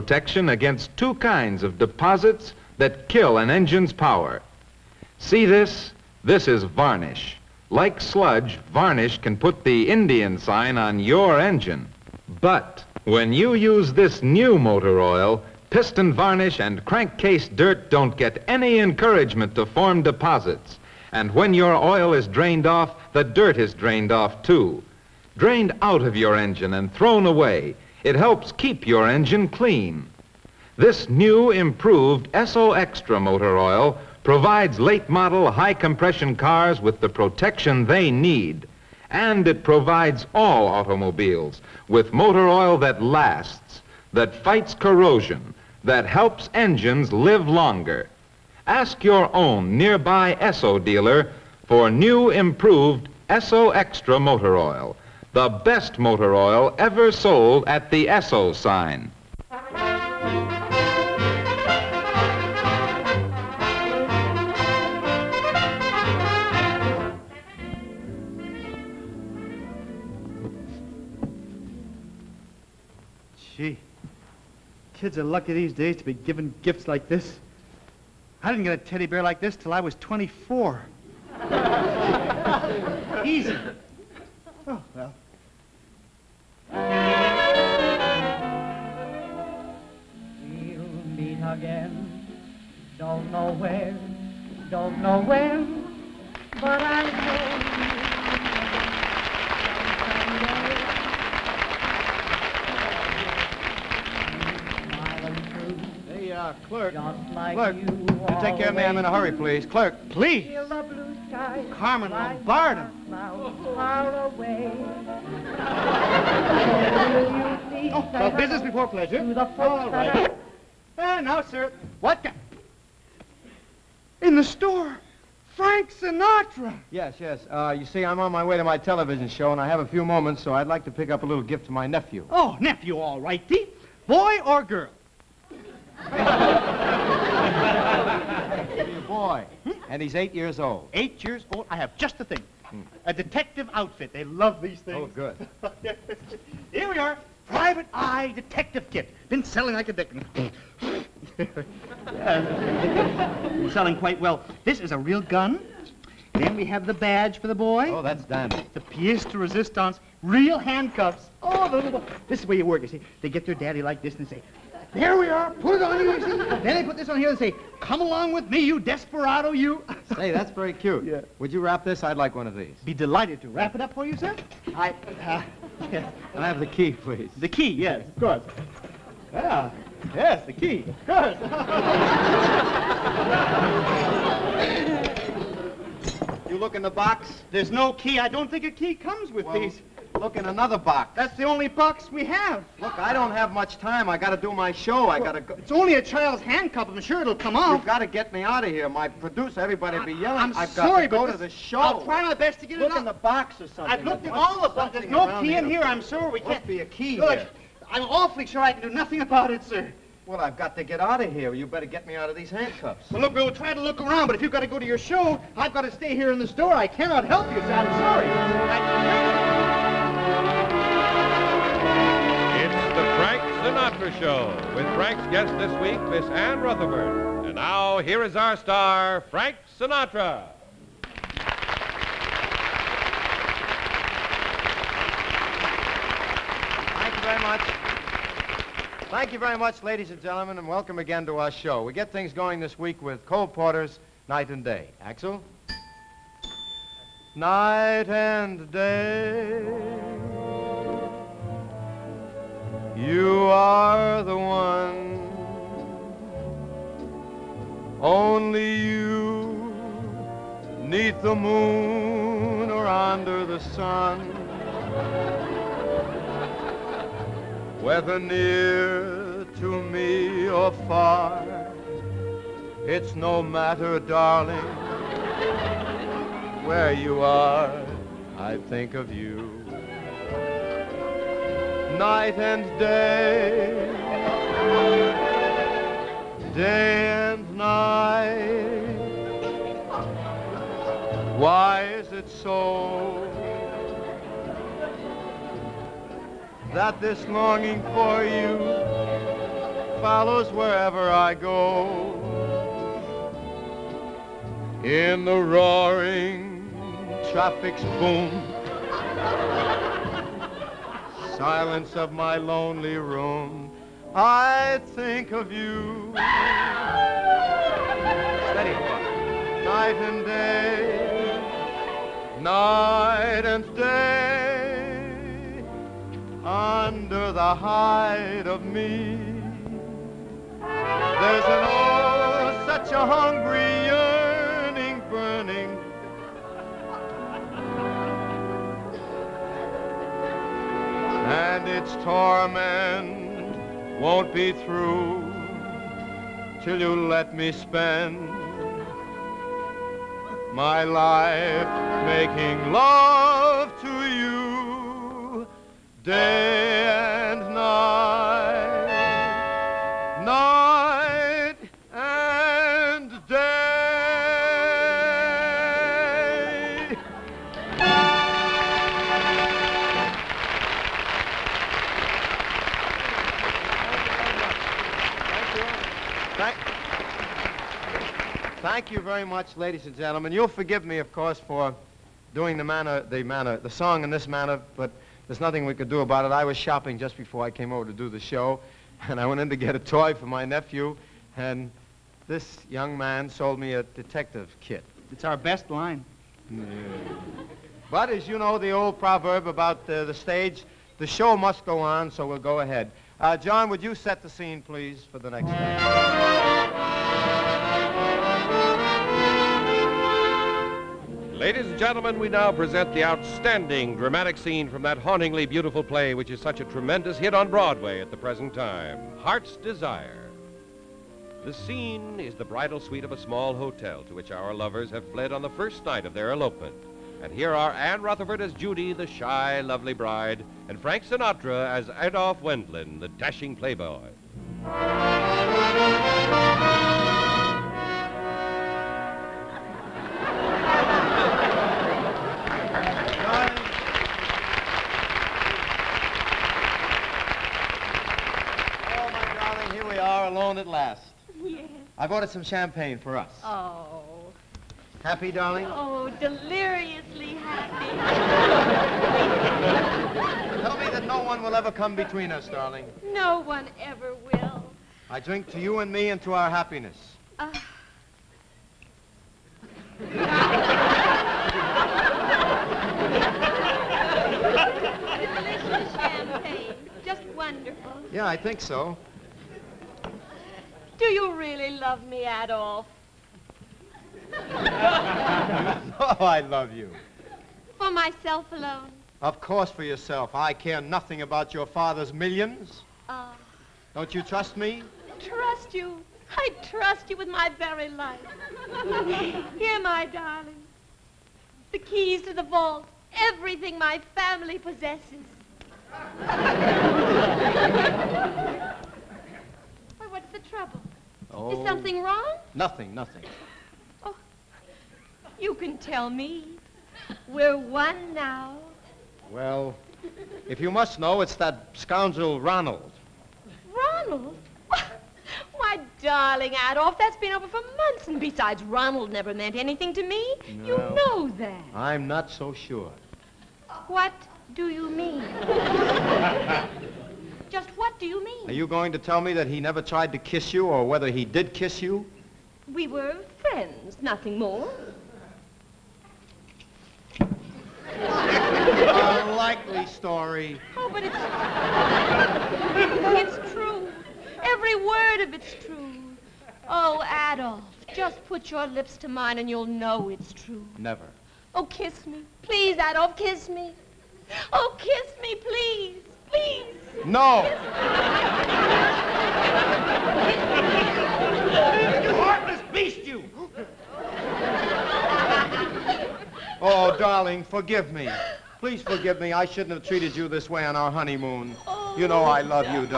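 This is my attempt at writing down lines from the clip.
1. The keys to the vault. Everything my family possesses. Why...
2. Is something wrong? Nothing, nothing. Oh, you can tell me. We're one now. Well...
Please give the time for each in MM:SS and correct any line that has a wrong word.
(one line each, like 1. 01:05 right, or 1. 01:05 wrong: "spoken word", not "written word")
1. 08:21 right
2. 08:31 right.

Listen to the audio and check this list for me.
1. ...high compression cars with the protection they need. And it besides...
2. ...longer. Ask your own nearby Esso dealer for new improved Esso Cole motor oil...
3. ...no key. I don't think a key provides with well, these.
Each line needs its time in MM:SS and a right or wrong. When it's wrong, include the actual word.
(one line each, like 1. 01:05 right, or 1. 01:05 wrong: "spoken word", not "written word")
1. 00:35 wrong: "provides", not "besides"
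2. 00:47 wrong: "Extra", not "Cole"
3. 03:07 wrong: "comes", not "provides".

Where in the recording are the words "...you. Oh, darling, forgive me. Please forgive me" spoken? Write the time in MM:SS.
09:33.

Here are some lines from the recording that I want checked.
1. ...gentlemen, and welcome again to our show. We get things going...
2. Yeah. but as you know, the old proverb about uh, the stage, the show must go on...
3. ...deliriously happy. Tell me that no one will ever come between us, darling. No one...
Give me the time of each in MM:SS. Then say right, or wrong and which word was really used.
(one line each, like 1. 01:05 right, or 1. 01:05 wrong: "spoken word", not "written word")
1. 04:00 right
2. 06:36 right
3. 07:36 right.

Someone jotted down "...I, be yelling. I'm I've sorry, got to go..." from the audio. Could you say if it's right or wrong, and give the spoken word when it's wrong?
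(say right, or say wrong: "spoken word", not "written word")
right.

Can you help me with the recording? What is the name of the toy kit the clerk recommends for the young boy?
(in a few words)
Private Eye Detective Kit.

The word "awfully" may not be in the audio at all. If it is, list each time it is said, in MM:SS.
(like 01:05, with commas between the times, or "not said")
03:28.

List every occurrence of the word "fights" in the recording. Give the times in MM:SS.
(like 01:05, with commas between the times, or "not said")
00:44.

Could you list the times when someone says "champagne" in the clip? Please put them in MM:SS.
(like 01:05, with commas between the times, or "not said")
07:32, 07:55.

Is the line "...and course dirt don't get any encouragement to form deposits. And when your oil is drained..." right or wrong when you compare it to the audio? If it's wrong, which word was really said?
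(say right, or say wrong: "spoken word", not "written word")
wrong: "crankcase", not "course".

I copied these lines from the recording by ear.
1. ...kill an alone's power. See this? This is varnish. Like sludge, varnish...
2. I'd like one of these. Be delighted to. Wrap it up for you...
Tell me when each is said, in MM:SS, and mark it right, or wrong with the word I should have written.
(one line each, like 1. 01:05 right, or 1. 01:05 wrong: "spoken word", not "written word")
1. 00:03 wrong: "engine", not "alone"
2. 02:52 right.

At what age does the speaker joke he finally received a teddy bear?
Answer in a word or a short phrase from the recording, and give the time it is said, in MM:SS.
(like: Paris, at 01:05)
24, at 01:20.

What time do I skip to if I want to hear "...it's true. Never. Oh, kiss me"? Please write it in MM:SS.
09:20.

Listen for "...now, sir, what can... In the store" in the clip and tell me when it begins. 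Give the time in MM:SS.
02:01.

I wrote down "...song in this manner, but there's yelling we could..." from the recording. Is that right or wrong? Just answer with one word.
wrong.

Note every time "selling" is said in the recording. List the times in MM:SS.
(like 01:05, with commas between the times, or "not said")
02:29, 02:33.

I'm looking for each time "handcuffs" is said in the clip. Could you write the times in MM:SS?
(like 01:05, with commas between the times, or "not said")
02:40, 03:16, 03:32.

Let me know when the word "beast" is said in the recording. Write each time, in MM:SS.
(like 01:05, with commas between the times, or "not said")
09:32.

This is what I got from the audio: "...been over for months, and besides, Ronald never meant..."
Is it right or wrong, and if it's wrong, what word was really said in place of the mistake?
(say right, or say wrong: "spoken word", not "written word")
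right.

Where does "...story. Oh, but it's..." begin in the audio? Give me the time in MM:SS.
09:09.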